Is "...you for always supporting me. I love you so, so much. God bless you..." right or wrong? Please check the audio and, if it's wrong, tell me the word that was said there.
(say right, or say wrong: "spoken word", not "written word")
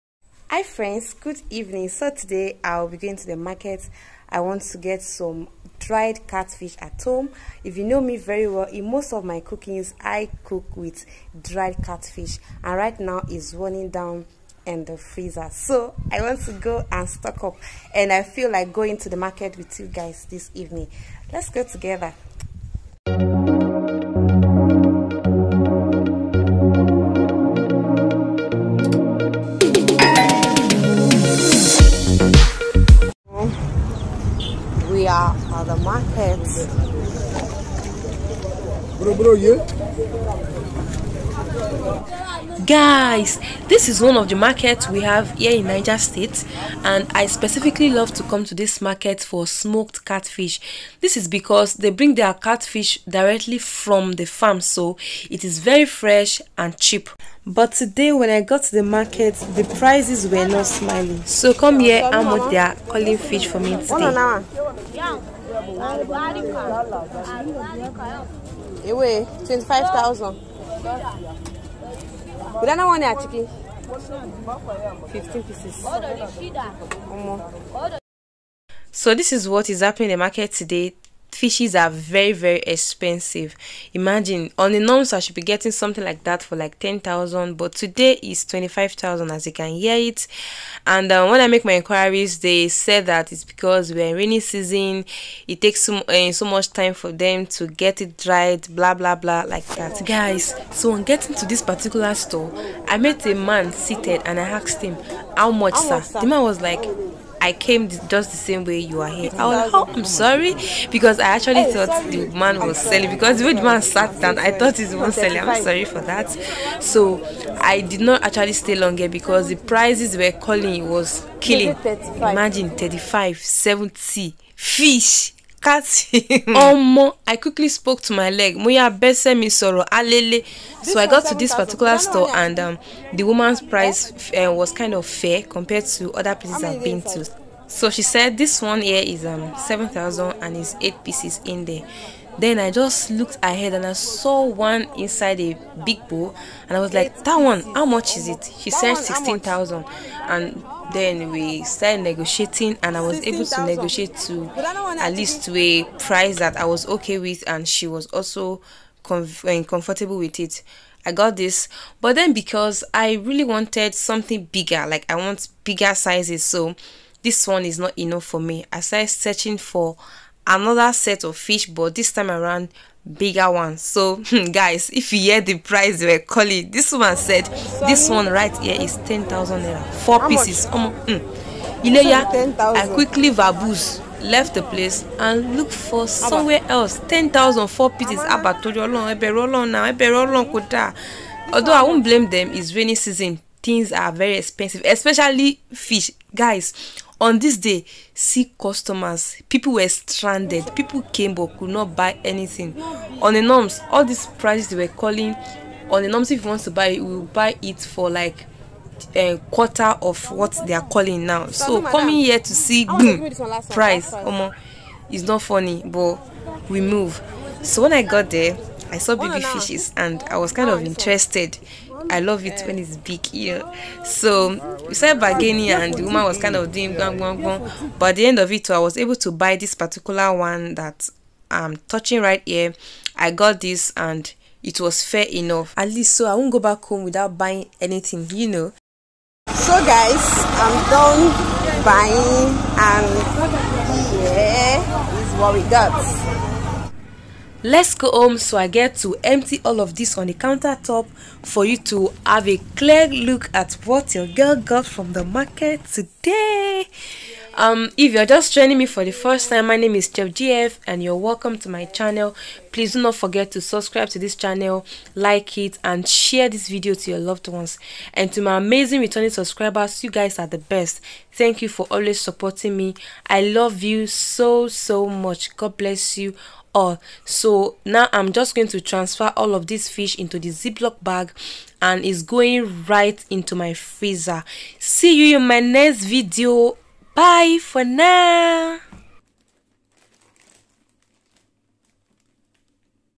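right.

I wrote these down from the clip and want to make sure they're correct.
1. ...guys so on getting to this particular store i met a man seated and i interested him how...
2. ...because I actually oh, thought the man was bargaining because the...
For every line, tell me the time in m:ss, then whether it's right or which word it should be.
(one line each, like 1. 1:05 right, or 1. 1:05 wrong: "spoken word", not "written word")
1. 1:40 wrong: "asked", not "interested"
2. 1:50 wrong: "selling", not "bargaining".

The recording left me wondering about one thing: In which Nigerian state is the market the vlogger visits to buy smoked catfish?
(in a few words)
Niger State.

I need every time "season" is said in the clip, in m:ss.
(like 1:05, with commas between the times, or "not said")
1:34, 3:12.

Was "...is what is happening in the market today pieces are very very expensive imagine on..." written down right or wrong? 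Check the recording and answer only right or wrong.
wrong.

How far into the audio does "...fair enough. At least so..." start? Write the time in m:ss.
3:55.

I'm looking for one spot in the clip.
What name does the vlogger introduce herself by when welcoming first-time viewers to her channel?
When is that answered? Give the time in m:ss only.
4:20.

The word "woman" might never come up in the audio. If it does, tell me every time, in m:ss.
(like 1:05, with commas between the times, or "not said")
2:13, 3:46.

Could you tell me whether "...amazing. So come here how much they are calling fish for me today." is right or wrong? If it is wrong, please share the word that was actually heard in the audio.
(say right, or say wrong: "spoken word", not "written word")
wrong: "smiling", not "amazing".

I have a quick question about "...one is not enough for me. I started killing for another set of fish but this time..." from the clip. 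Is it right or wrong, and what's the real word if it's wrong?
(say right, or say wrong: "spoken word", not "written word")
wrong: "searching", not "killing".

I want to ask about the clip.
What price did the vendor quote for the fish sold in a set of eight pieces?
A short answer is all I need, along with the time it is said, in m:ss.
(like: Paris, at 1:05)
7000, at 2:19.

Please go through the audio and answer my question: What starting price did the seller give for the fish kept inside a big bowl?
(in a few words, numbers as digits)
16,000.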